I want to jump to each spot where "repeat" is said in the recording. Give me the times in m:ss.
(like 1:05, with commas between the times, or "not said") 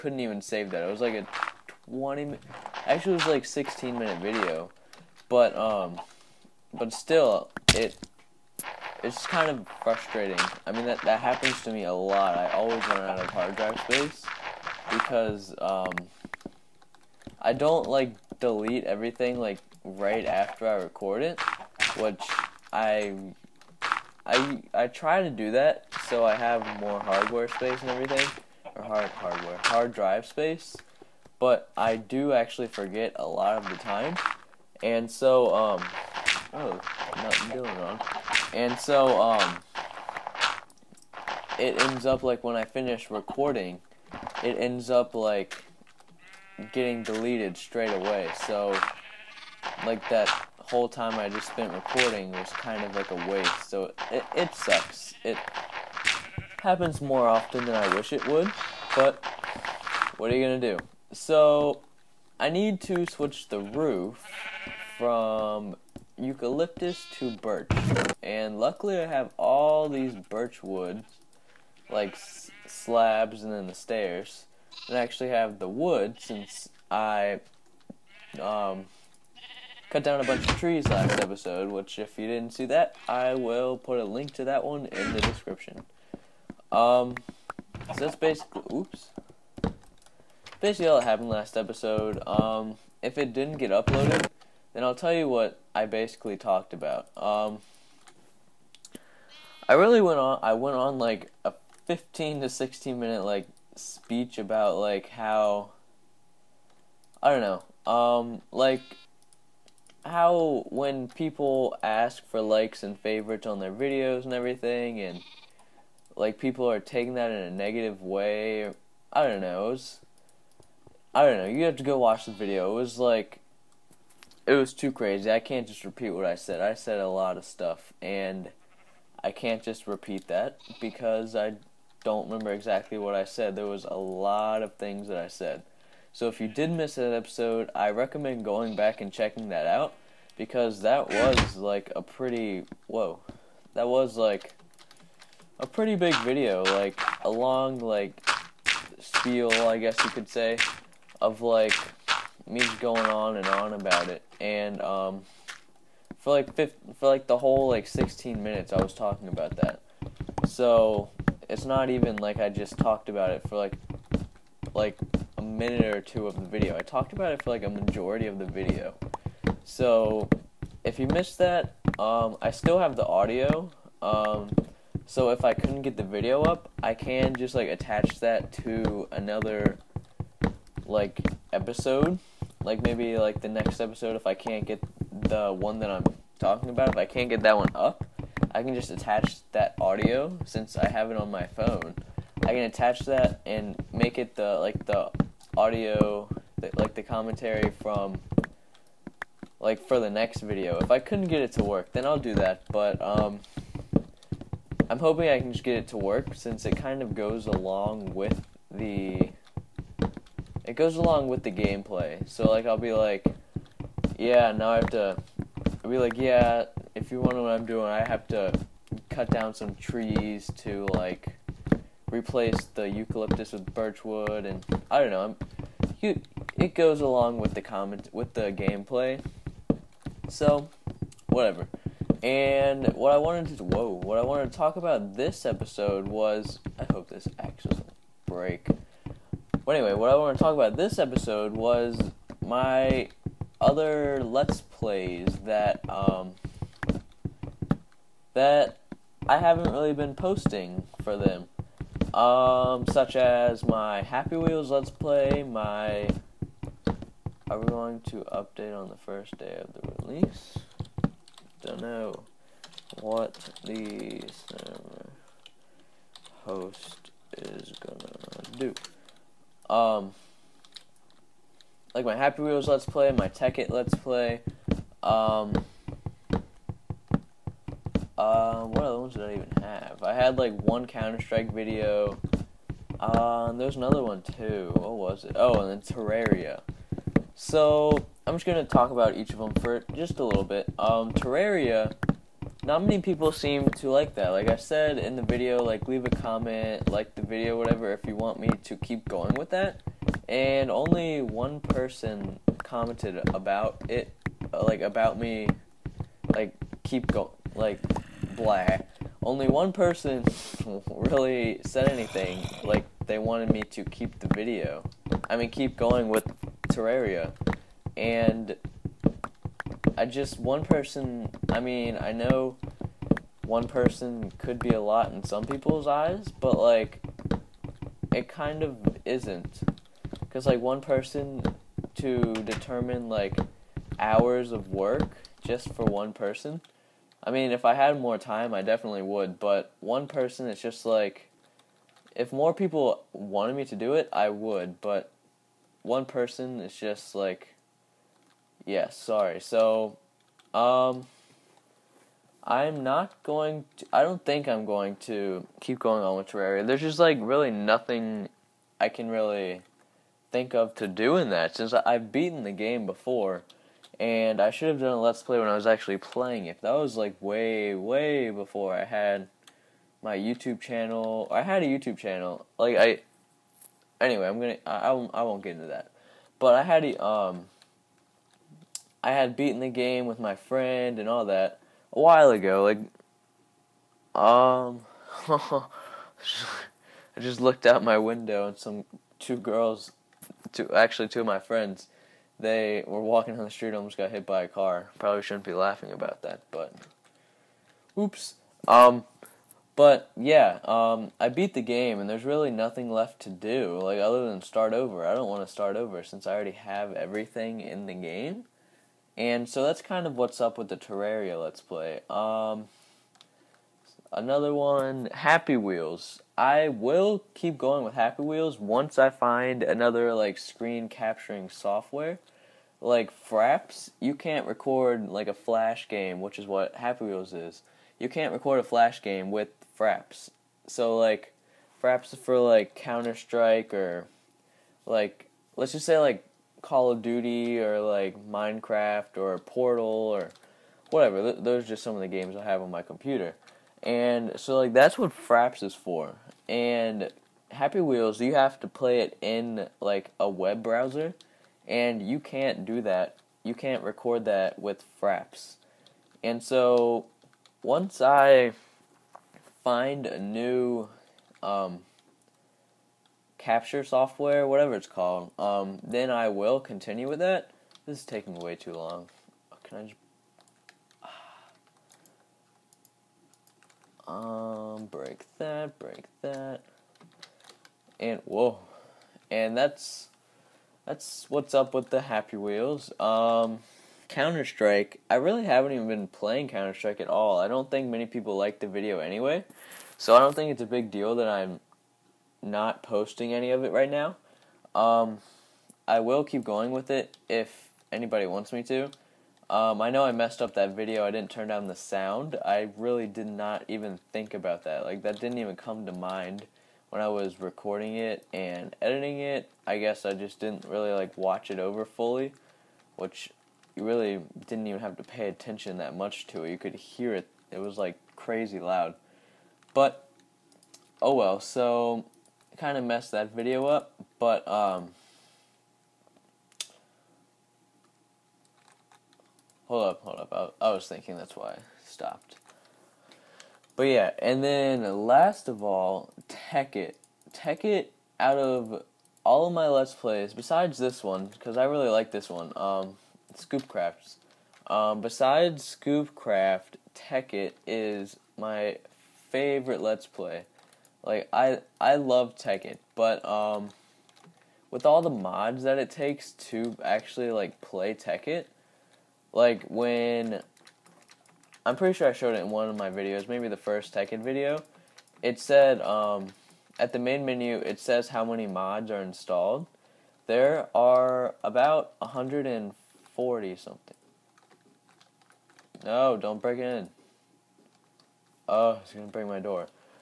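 2:05, 2:09.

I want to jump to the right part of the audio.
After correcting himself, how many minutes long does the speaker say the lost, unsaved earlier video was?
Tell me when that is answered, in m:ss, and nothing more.
0:03.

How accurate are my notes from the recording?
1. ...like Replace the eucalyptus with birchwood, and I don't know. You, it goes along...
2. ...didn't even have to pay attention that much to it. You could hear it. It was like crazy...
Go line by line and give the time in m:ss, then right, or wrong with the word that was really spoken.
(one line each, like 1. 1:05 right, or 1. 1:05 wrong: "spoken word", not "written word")
1. 3:40 right
2. 8:34 right.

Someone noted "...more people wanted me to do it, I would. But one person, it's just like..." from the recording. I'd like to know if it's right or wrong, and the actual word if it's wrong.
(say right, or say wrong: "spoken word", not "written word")
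right.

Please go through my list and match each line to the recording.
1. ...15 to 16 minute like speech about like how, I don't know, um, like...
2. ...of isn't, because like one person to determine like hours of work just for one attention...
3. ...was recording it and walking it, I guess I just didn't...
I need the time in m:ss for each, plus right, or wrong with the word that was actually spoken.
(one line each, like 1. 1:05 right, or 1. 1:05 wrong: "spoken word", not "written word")
1. 1:41 right
2. 5:28 wrong: "person", not "attention"
3. 8:27 wrong: "editing", not "walking".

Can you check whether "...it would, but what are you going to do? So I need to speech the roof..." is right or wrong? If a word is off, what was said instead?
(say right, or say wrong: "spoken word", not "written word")
wrong: "switch", not "speech".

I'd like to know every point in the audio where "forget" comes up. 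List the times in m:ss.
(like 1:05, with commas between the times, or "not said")
0:32.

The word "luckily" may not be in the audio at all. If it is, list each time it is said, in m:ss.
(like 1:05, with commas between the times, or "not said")
1:08.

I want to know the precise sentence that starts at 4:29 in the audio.
Um, like my Happy Wheels Let's Play, my Tekkit Let's Play, um, did I even have?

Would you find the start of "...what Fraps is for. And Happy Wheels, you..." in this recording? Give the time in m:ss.
7:24.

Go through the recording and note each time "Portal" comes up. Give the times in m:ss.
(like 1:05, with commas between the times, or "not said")
7:19.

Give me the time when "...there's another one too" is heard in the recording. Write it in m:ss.
4:43.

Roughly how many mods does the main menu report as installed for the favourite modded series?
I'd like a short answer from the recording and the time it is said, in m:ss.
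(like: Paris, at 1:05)
140, at 9:31.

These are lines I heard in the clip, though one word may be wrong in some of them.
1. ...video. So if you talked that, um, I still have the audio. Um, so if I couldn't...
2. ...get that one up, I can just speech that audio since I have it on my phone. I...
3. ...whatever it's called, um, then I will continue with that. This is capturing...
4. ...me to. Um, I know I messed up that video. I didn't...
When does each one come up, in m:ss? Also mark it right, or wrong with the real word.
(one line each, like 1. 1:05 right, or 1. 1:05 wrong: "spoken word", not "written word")
1. 2:48 wrong: "missed", not "talked"
2. 3:07 wrong: "attach", not "speech"
3. 7:44 wrong: "taking", not "capturing"
4. 8:18 right.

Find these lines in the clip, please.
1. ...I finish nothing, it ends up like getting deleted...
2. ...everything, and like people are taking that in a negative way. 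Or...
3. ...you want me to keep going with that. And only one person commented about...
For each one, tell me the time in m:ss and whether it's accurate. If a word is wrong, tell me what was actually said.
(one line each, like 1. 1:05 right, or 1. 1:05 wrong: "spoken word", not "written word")
1. 0:42 wrong: "recording", not "nothing"
2. 1:54 right
3. 4:58 right.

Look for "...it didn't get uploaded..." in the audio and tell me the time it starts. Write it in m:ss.
1:33.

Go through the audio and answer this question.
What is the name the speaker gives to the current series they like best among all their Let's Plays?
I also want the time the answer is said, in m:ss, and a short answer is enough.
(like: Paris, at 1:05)
Scoopcraft, at 9:03.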